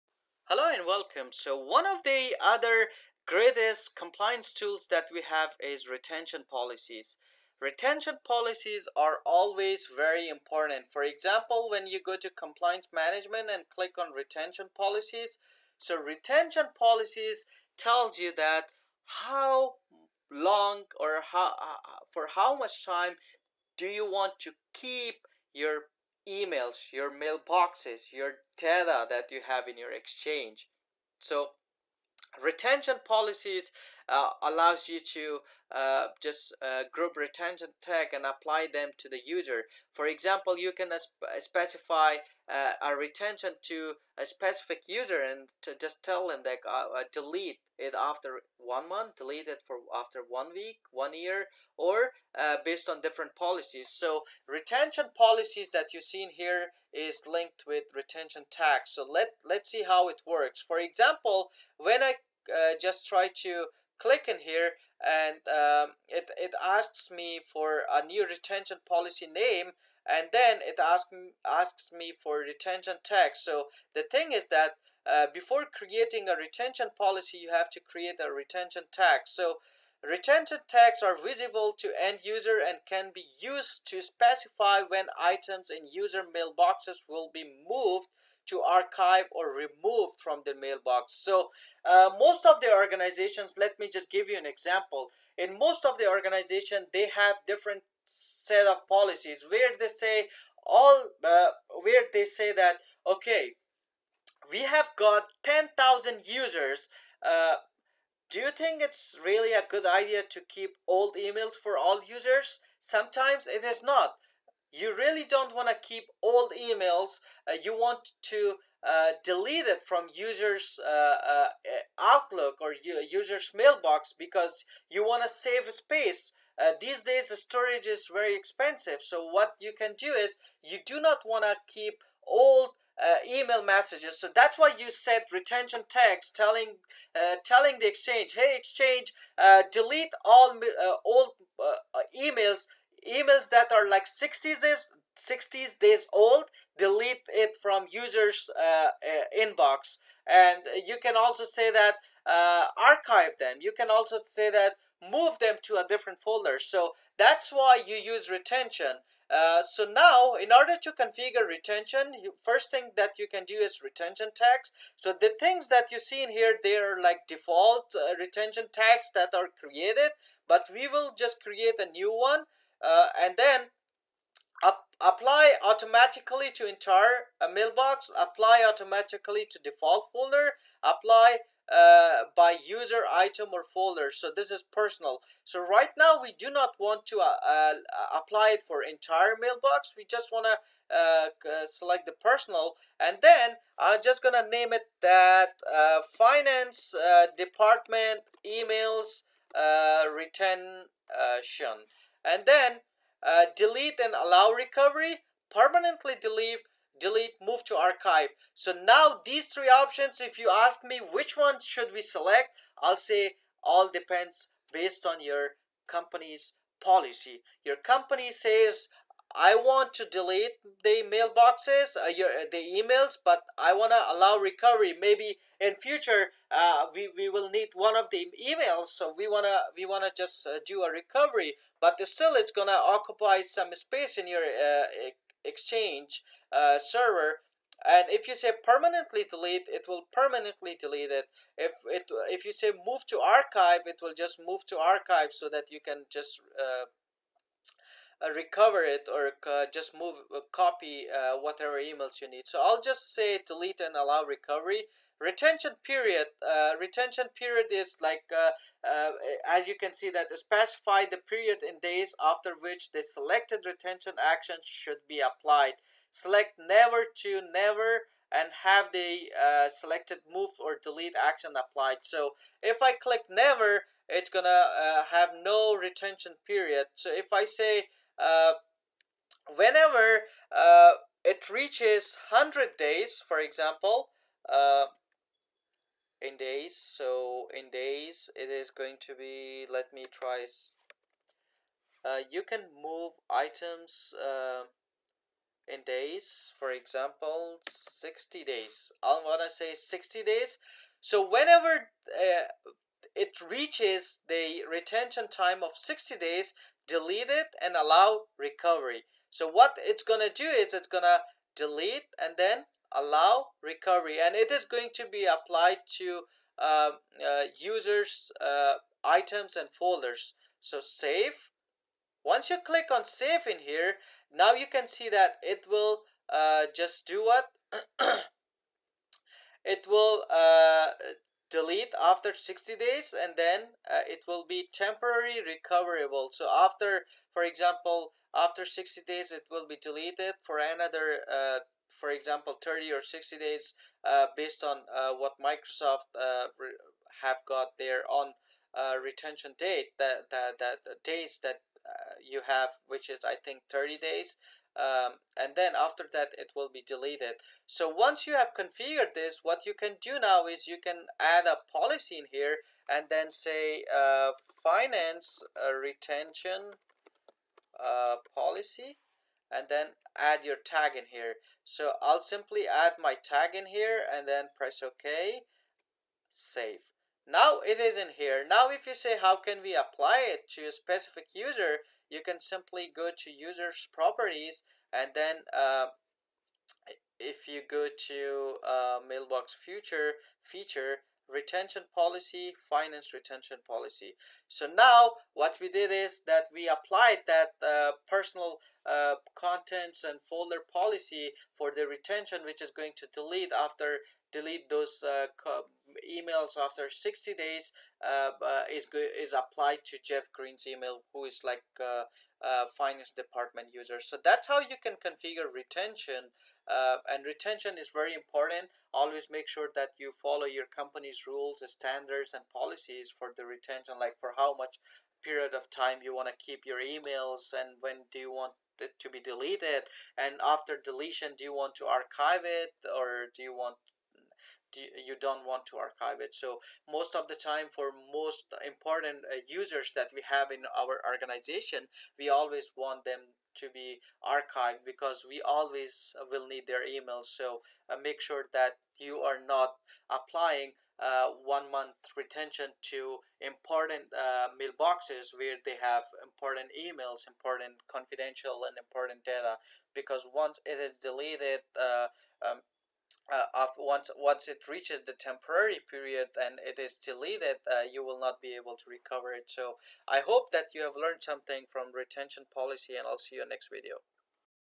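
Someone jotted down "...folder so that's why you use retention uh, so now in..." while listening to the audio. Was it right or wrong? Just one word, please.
right.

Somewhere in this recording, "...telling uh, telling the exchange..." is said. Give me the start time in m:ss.
2:16.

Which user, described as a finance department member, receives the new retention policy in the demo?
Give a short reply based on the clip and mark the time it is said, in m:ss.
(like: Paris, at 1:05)
Jeff Green, at 6:50.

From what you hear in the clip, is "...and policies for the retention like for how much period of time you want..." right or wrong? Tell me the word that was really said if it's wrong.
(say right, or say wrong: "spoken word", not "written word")
right.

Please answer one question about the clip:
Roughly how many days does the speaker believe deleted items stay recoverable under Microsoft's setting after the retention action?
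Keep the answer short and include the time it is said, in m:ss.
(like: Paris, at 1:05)
30 days, at 5:52.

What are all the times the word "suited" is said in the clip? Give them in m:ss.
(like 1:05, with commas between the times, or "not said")
not said.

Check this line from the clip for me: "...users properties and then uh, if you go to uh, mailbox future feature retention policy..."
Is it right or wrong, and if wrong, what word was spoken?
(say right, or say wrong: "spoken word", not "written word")
right.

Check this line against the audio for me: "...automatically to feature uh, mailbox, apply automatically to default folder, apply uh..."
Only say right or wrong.
wrong.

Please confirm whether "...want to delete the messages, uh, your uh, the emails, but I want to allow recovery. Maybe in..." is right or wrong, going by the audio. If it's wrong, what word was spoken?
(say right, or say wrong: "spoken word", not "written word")
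wrong: "mailboxes", not "messages".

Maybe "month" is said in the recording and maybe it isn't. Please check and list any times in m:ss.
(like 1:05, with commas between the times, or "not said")
0:48, 7:31.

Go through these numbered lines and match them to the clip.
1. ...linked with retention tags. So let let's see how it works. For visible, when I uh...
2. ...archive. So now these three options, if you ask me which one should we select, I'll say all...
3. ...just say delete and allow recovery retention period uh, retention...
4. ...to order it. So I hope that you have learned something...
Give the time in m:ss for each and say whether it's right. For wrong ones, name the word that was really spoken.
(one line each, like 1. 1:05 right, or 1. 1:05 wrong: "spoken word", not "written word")
1. 0:57 wrong: "example", not "visible"
2. 3:27 right
3. 4:12 right
4. 7:48 wrong: "recover", not "order".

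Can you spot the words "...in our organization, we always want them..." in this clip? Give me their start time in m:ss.
7:20.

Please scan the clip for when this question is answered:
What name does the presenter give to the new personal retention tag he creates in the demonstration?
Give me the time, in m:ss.
3:16.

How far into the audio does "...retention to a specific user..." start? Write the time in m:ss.
0:42.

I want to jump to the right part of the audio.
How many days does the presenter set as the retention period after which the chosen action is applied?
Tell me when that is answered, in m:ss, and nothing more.
4:57.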